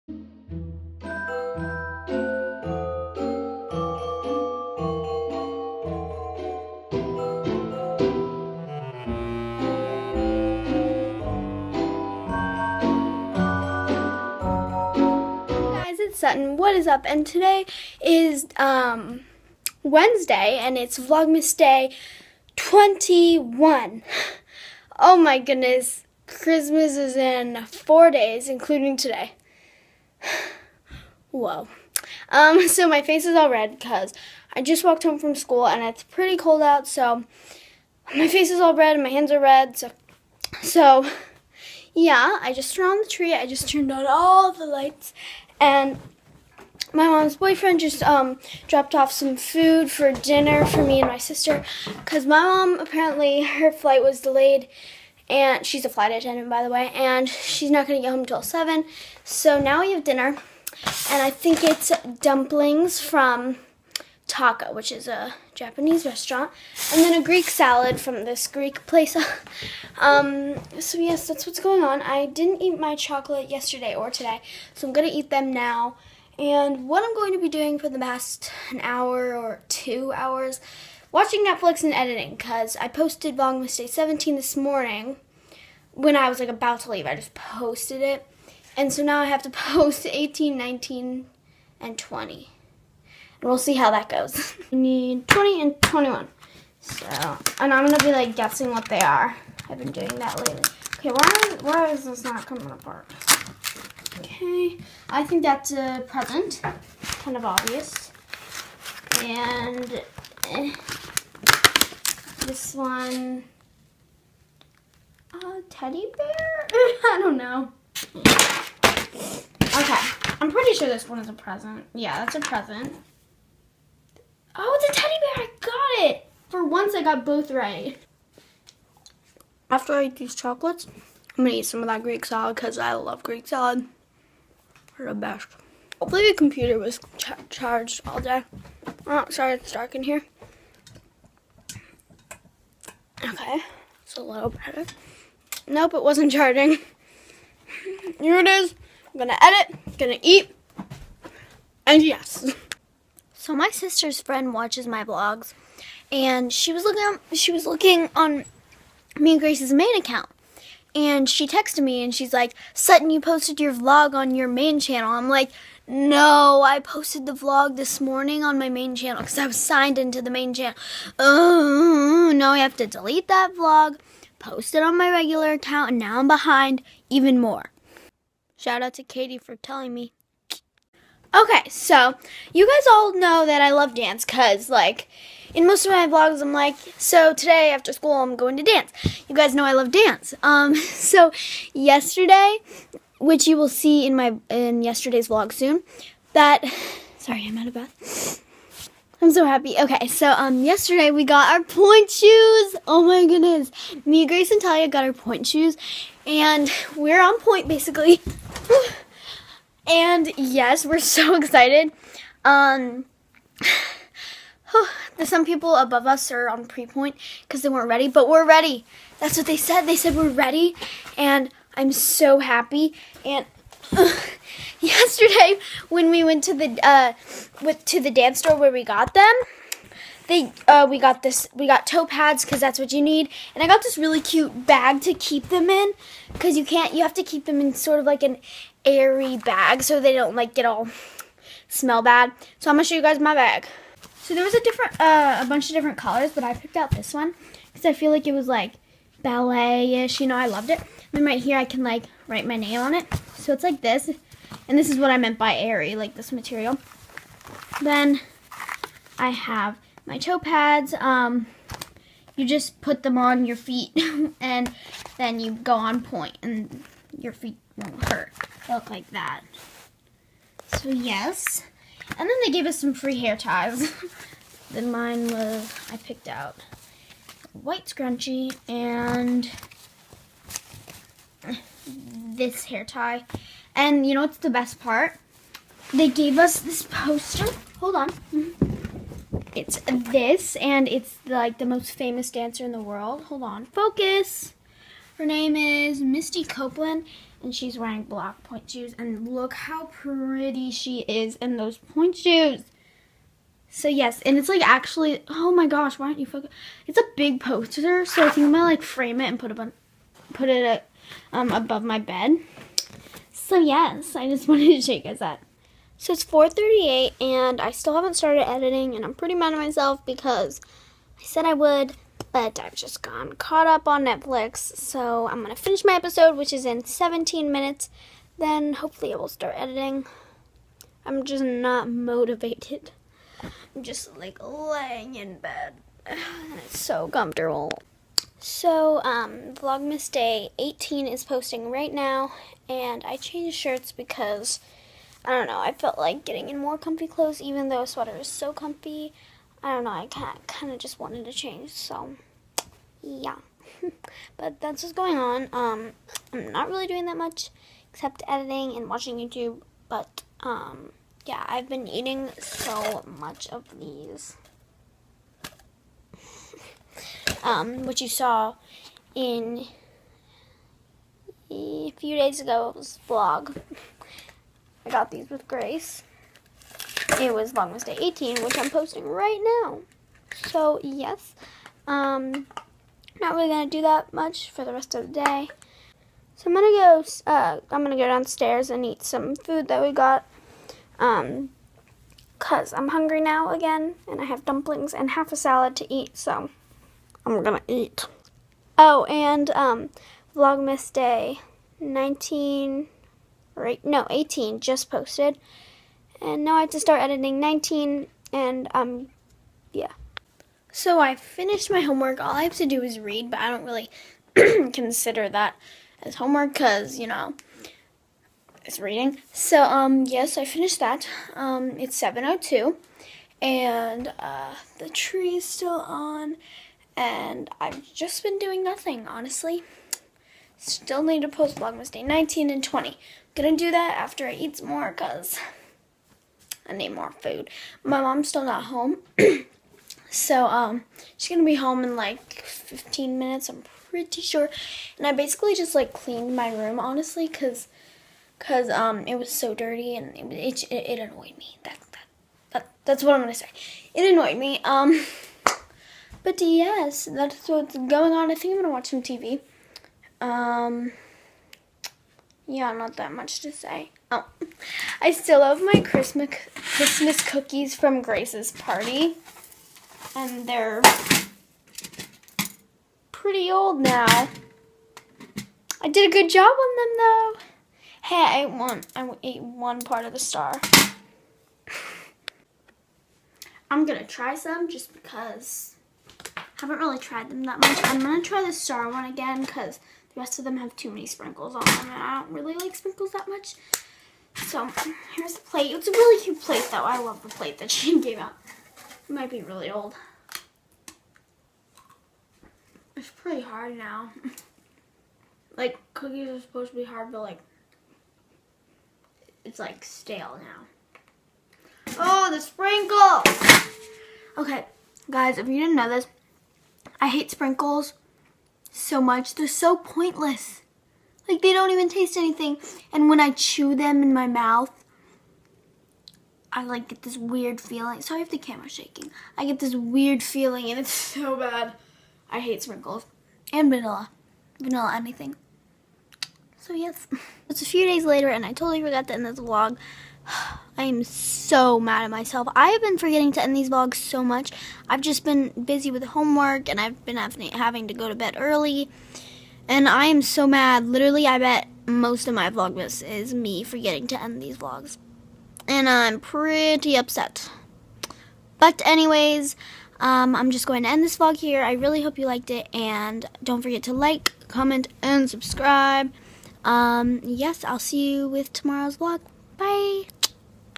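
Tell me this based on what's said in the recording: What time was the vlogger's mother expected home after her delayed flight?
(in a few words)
7.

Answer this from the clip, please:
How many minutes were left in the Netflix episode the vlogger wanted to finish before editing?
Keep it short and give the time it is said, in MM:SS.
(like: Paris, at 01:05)
17, at 05:26.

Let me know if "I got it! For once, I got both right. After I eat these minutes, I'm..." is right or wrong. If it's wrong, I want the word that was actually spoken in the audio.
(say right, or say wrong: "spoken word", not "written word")
wrong: "chocolates", not "minutes".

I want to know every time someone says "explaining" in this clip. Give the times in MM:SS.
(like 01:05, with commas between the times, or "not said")
not said.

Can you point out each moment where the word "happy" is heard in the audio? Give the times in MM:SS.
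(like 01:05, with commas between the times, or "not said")
03:19, 03:42.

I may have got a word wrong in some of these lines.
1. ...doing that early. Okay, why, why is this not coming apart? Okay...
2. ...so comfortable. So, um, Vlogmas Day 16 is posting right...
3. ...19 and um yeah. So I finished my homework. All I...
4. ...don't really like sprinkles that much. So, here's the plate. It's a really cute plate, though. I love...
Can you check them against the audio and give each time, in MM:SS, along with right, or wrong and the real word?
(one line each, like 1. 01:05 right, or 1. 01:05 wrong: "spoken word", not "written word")
1. 01:39 wrong: "lately", not "early"
2. 05:36 wrong: "18", not "16"
3. 06:47 right
4. 08:12 right.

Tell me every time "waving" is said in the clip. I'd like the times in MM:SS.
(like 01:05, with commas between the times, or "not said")
not said.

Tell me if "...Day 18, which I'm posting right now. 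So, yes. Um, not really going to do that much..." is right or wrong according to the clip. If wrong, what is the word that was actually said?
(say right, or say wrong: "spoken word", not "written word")
right.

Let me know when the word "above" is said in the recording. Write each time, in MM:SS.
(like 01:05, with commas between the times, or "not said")
03:35, 05:11.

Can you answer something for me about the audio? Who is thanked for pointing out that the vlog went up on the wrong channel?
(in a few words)
Katie.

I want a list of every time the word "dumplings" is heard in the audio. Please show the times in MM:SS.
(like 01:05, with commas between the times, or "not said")
01:02, 06:34.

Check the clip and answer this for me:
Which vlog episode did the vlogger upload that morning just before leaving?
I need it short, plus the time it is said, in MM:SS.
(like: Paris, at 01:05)
Vlogmas day 17, at 01:23.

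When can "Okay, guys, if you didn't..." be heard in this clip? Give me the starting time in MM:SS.
08:34.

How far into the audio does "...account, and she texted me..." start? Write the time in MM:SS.
02:39.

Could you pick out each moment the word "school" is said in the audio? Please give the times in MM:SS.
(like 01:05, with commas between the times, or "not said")
00:35, 03:07.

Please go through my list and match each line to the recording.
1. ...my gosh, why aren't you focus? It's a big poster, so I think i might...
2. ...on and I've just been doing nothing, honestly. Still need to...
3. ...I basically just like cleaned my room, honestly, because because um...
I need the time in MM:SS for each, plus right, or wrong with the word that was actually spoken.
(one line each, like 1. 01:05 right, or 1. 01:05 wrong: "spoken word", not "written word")
1. 05:05 right
2. 07:05 right
3. 07:25 right.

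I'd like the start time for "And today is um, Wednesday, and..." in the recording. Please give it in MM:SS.
00:17.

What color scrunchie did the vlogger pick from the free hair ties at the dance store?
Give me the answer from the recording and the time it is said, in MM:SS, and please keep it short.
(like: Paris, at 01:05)
White, at 04:37.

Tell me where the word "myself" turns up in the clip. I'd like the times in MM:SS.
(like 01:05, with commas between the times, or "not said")
05:19, 09:02.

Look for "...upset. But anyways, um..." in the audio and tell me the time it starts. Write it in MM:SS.
09:16.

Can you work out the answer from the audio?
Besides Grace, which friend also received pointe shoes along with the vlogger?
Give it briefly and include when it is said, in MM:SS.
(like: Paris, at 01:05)
Talia, at 03:24.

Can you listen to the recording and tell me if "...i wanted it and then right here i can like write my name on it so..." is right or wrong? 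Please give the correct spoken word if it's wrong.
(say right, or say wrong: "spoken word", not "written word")
wrong: "loved", not "wanted".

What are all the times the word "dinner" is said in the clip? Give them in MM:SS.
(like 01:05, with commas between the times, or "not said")
00:50, 01:00.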